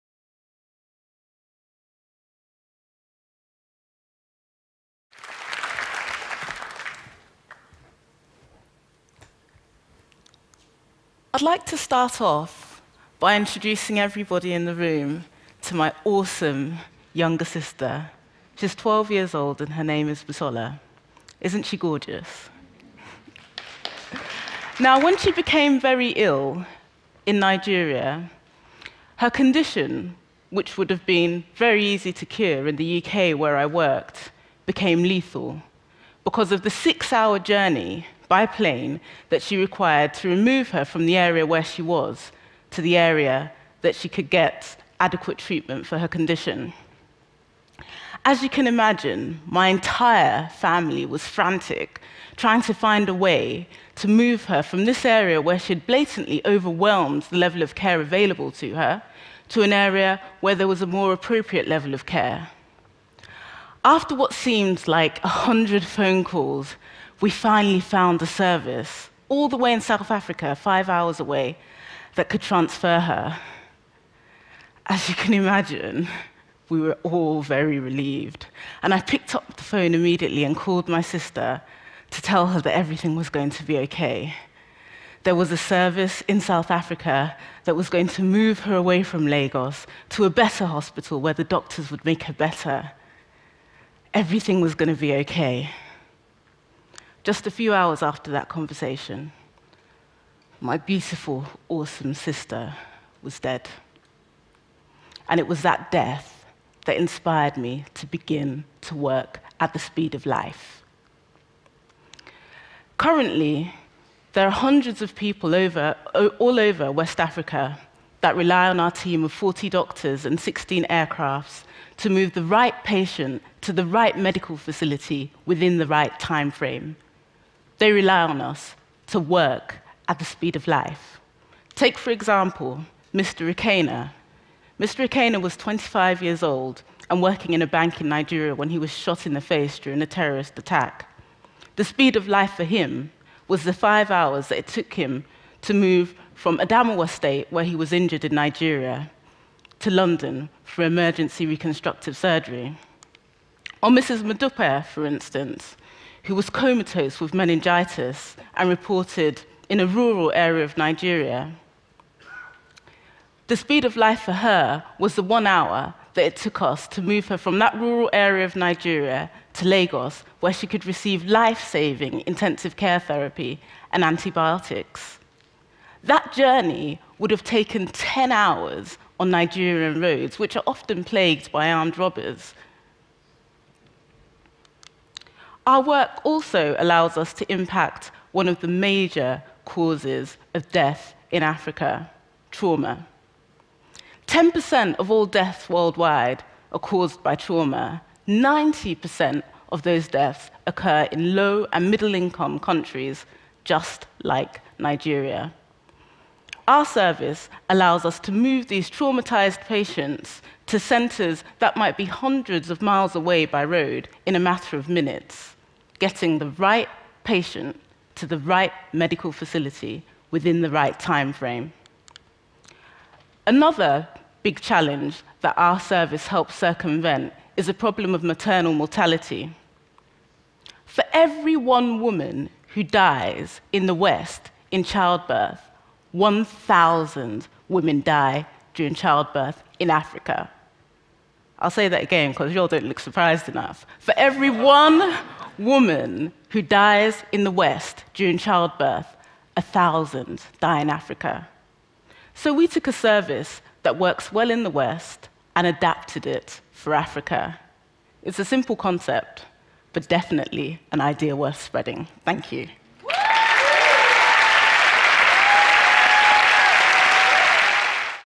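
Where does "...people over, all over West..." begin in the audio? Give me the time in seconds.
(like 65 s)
115 s.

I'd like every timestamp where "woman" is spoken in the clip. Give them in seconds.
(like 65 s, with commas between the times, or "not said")
231 s, 245 s.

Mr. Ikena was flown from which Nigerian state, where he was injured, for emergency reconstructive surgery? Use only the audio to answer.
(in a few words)
Adamawa State.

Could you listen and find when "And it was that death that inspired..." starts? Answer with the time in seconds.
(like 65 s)
105 s.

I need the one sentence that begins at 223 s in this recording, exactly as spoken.
Another big challenge that our service helps circumvent is a problem of maternal mortality.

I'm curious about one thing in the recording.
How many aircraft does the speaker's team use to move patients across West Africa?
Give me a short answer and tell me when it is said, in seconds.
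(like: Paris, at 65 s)
16, at 120 s.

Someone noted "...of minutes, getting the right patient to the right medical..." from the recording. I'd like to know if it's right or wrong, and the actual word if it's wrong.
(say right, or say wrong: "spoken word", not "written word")
right.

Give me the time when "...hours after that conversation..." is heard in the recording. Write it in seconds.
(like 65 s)
97 s.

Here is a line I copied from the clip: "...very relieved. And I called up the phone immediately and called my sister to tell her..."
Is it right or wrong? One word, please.
wrong.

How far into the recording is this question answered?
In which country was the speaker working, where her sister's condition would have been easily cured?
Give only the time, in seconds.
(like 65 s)
33 s.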